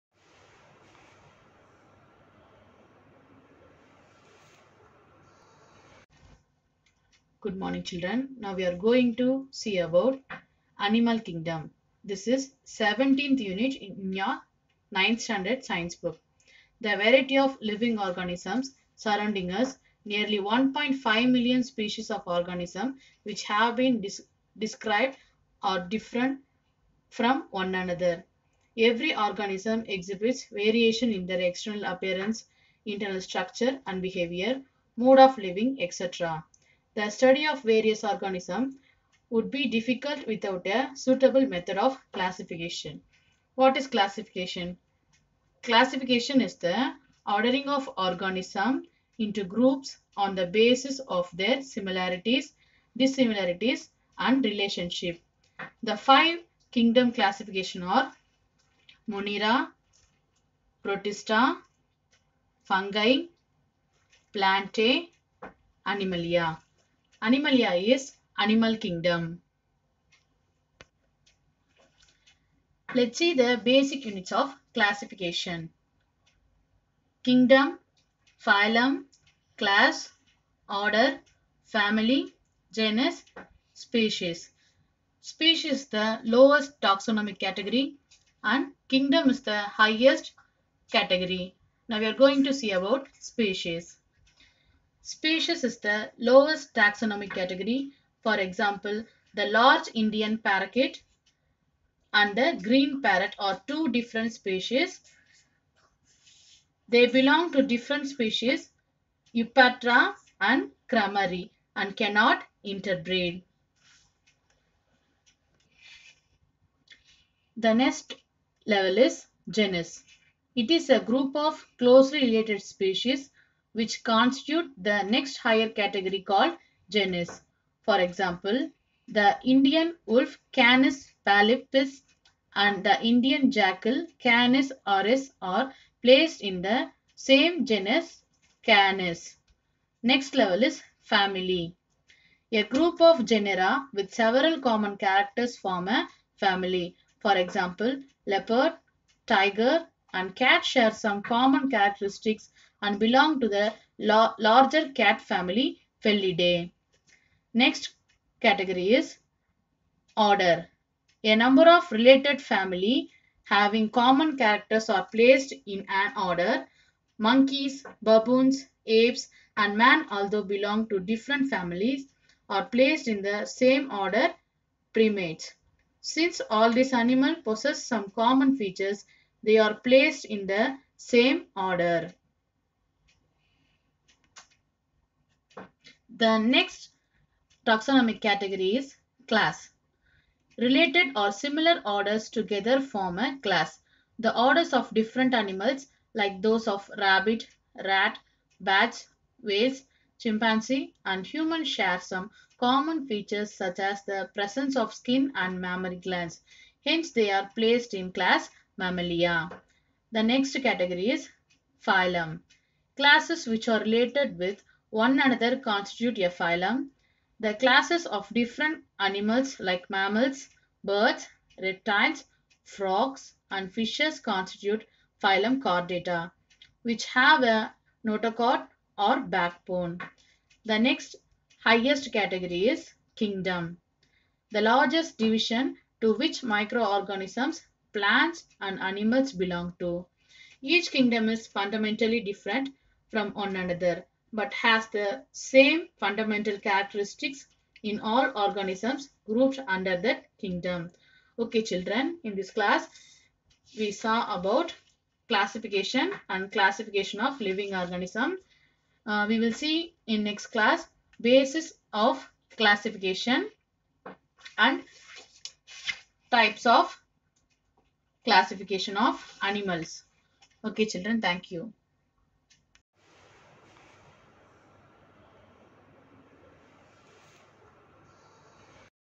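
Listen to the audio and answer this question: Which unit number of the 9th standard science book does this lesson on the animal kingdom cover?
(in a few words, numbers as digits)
17th.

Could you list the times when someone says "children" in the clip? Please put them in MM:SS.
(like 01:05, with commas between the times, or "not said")
00:07, 04:11, 04:30.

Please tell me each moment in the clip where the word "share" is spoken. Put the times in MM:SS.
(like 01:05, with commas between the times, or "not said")
02:30, 03:21.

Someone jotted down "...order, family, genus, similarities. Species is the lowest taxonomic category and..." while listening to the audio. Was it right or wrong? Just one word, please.
wrong.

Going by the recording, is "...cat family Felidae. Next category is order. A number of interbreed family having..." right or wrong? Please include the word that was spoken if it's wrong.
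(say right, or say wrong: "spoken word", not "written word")
wrong: "related", not "interbreed".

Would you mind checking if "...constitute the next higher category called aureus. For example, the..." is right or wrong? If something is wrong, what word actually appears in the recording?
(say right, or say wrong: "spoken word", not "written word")
wrong: "genus", not "aureus".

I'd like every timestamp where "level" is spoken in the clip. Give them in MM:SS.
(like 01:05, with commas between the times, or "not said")
01:58, 02:20.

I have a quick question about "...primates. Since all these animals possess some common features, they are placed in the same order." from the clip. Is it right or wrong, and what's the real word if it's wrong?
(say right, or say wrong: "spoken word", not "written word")
right.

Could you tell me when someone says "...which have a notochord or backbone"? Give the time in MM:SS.
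03:46.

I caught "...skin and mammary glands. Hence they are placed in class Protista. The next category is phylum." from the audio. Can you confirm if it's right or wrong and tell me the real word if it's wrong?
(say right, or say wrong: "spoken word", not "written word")
wrong: "Mammalia", not "Protista".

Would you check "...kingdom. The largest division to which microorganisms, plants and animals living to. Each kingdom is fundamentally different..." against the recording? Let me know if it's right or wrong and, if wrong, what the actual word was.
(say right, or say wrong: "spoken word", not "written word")
wrong: "belong", not "living".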